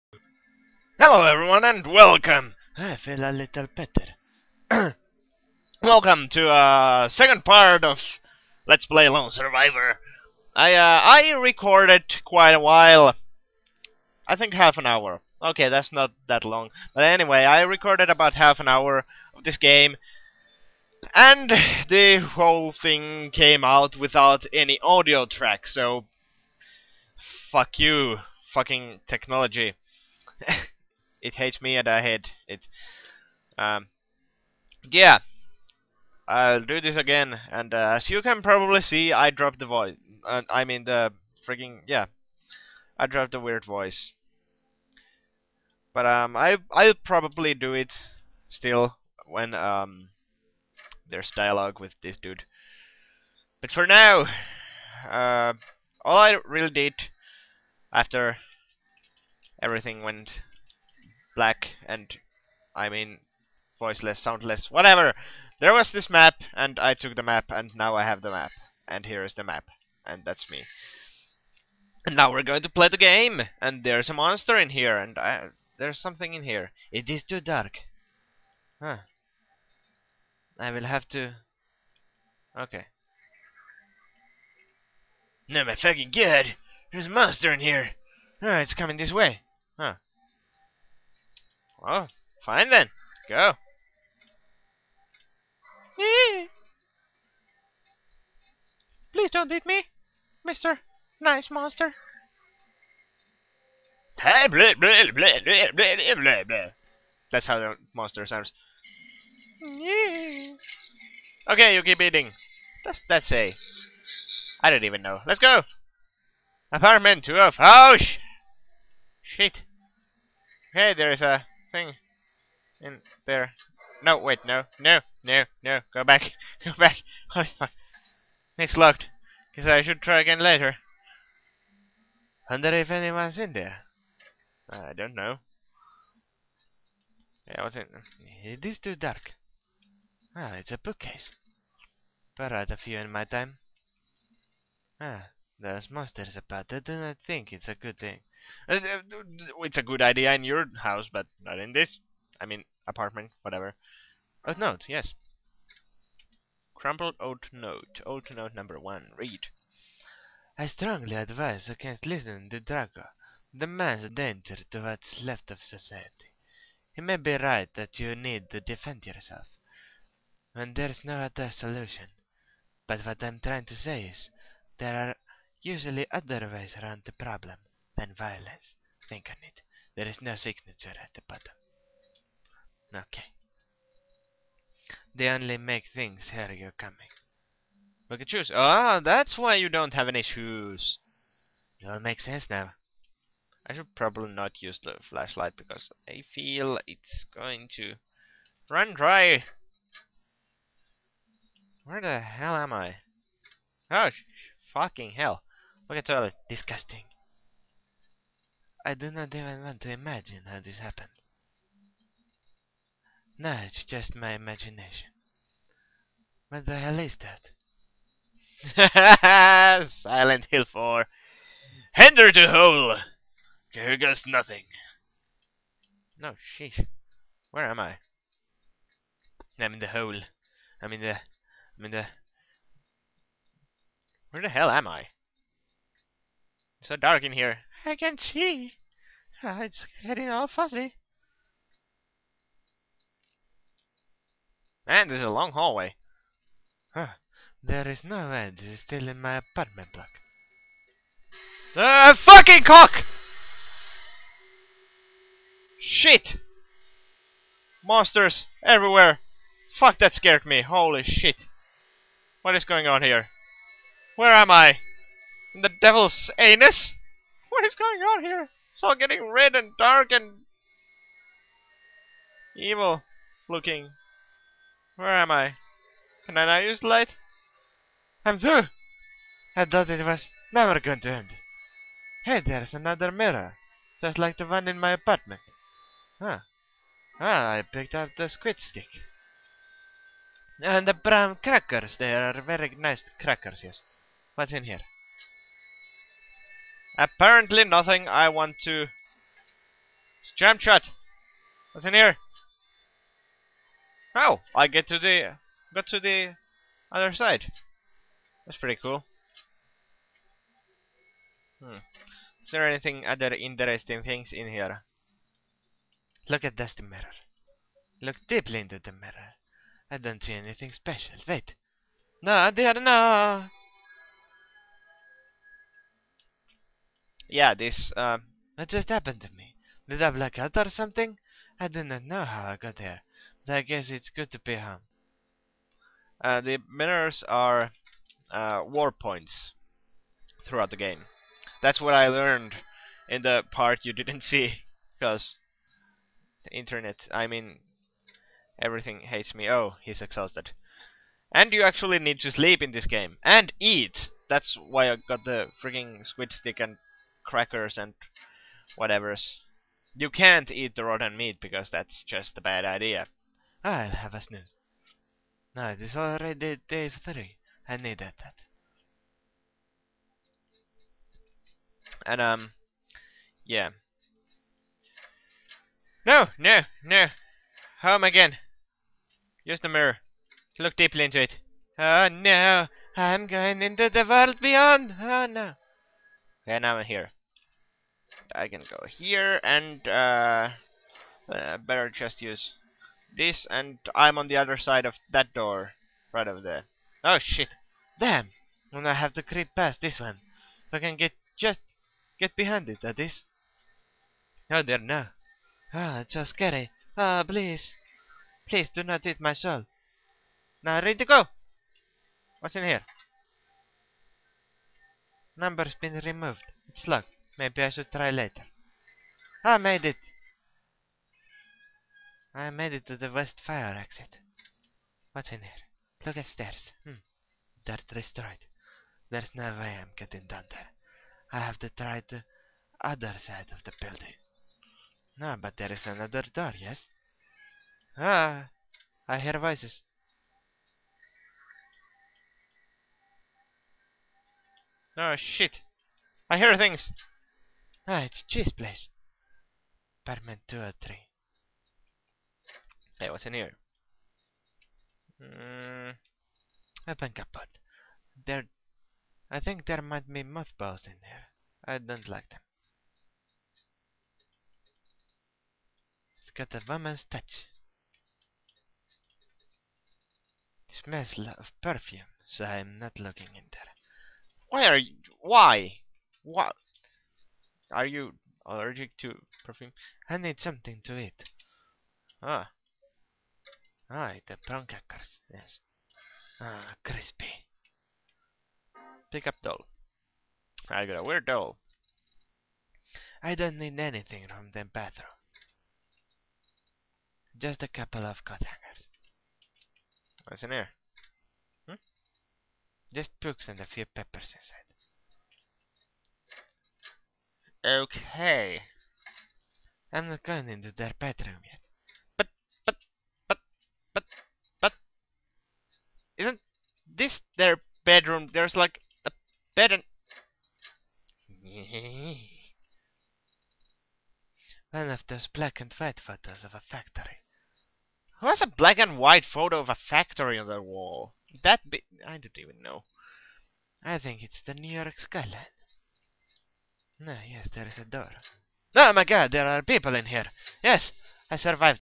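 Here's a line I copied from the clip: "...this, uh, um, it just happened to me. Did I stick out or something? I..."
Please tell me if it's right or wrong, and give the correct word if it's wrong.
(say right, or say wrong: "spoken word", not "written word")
wrong: "black", not "stick".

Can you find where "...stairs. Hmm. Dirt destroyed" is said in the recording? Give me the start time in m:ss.
7:06.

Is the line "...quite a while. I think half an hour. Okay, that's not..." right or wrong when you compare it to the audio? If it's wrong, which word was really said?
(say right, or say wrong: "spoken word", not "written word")
right.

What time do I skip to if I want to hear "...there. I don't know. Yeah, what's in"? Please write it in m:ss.
2:13.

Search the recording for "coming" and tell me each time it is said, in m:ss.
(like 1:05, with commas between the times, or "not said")
1:28, 3:06.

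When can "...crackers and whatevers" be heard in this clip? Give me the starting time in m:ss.
5:57.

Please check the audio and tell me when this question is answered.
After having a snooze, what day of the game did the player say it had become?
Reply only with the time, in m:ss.
6:06.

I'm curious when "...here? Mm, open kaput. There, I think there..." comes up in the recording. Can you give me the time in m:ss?
7:33.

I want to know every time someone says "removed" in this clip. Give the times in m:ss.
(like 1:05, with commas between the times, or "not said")
6:56.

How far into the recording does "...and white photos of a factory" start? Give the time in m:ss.
8:45.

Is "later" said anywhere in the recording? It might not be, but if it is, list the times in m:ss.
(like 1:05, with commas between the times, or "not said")
2:10, 6:58.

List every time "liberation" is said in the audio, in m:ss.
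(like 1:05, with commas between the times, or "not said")
not said.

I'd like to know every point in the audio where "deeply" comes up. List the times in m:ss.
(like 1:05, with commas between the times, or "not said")
5:18, 6:20.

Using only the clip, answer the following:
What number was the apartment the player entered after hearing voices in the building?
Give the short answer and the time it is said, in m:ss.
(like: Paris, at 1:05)
203, at 7:30.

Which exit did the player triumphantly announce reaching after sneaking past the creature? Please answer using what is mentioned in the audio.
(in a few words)
west fire exit.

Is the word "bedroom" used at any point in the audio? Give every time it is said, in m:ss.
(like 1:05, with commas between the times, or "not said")
8:30, 8:37.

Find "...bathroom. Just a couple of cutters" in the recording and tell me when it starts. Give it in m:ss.
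8:14.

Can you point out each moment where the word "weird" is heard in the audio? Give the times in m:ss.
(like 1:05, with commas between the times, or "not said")
0:43, 8:11.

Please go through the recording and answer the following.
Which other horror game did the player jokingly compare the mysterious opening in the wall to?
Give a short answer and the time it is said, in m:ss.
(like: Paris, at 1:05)
Silent Hill 4, at 3:39.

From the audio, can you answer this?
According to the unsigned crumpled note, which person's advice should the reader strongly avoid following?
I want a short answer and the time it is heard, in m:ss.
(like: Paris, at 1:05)
Draco, at 2:42.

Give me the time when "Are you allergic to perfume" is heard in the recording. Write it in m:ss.
7:57.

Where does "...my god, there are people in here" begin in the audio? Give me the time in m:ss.
8:58.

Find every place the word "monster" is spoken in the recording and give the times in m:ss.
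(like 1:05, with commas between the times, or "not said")
1:14, 1:27, 1:41, 1:47, 2:25, 4:17.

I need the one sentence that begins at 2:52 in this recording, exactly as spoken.
But what I'm trying to say is, there are Usually otherwise around the problem than violence.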